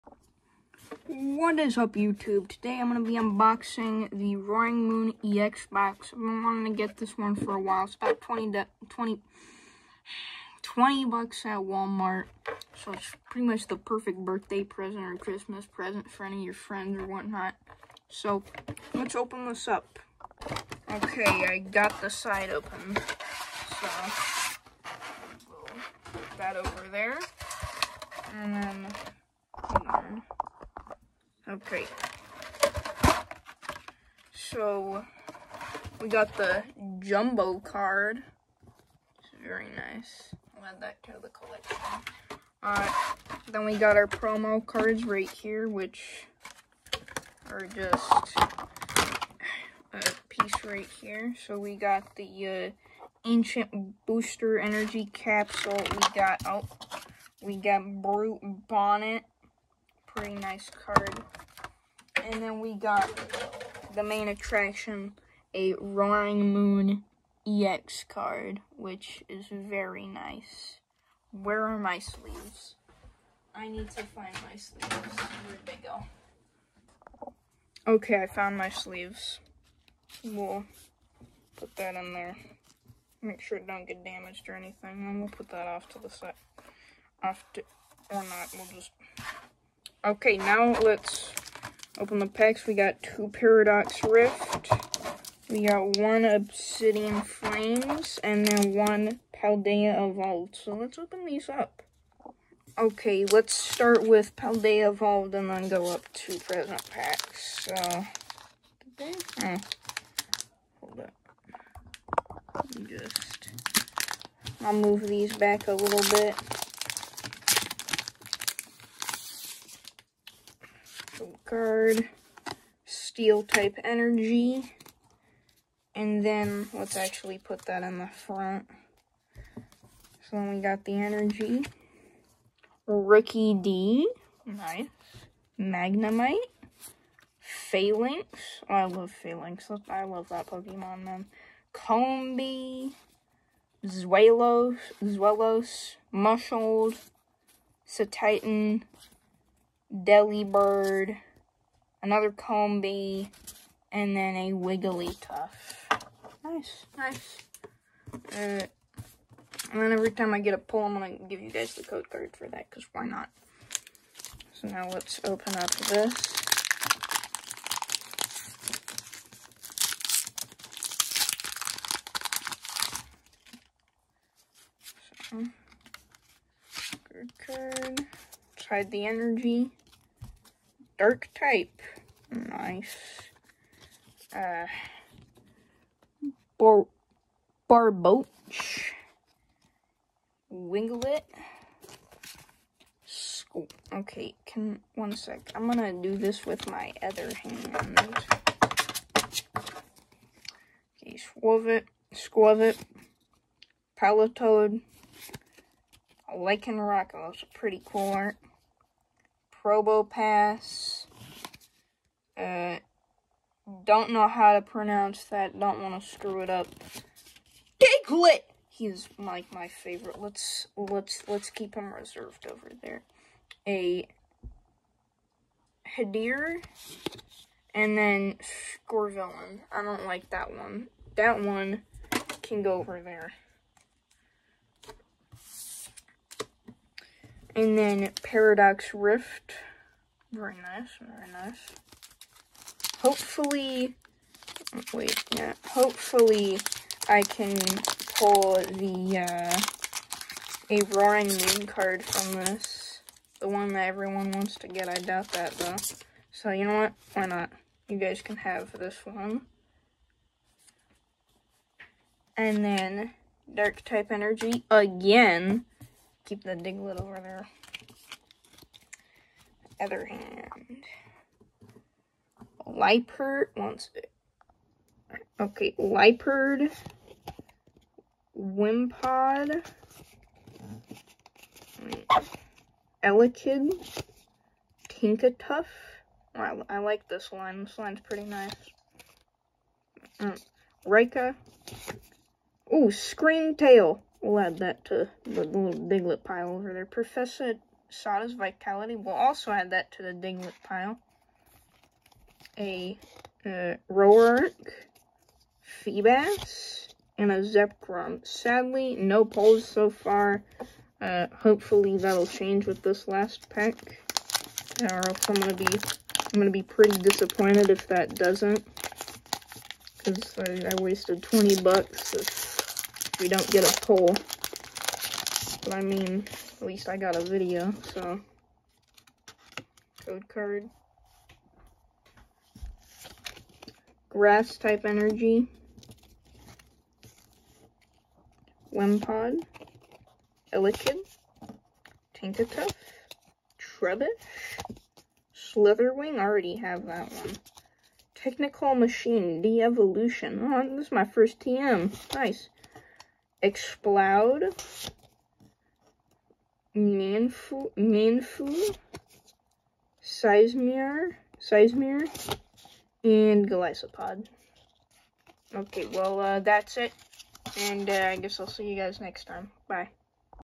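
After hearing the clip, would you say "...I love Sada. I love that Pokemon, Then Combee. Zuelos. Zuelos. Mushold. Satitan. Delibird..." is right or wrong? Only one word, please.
wrong.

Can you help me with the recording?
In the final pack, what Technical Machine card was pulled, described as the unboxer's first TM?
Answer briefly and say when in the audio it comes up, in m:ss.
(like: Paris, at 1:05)
De-Evolution, at 5:49.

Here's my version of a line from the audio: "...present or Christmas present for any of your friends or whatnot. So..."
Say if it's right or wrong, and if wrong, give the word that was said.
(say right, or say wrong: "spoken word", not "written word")
right.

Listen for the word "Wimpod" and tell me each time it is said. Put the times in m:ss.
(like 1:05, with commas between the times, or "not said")
4:38, 5:38.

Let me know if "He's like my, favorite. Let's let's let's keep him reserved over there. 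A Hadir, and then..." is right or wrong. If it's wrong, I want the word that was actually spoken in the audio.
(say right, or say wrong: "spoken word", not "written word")
right.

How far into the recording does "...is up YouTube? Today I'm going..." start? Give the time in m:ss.
0:01.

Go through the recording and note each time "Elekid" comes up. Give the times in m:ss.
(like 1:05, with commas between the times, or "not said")
4:43, 5:40.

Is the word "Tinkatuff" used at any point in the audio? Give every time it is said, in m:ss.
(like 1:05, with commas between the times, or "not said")
4:44, 5:42.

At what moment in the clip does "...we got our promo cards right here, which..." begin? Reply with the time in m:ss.
0:43.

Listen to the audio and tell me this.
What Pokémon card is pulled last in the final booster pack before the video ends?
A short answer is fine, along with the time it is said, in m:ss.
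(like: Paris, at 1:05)
Golisopod, at 6:03.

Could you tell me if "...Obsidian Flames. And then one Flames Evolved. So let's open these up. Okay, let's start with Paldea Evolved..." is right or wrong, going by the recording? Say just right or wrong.
wrong.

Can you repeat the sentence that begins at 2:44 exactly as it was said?
So now let's open up this.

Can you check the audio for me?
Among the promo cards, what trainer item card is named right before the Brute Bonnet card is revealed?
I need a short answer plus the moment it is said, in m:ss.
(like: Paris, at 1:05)
Ancient Booster Energy Capsule, at 0:53.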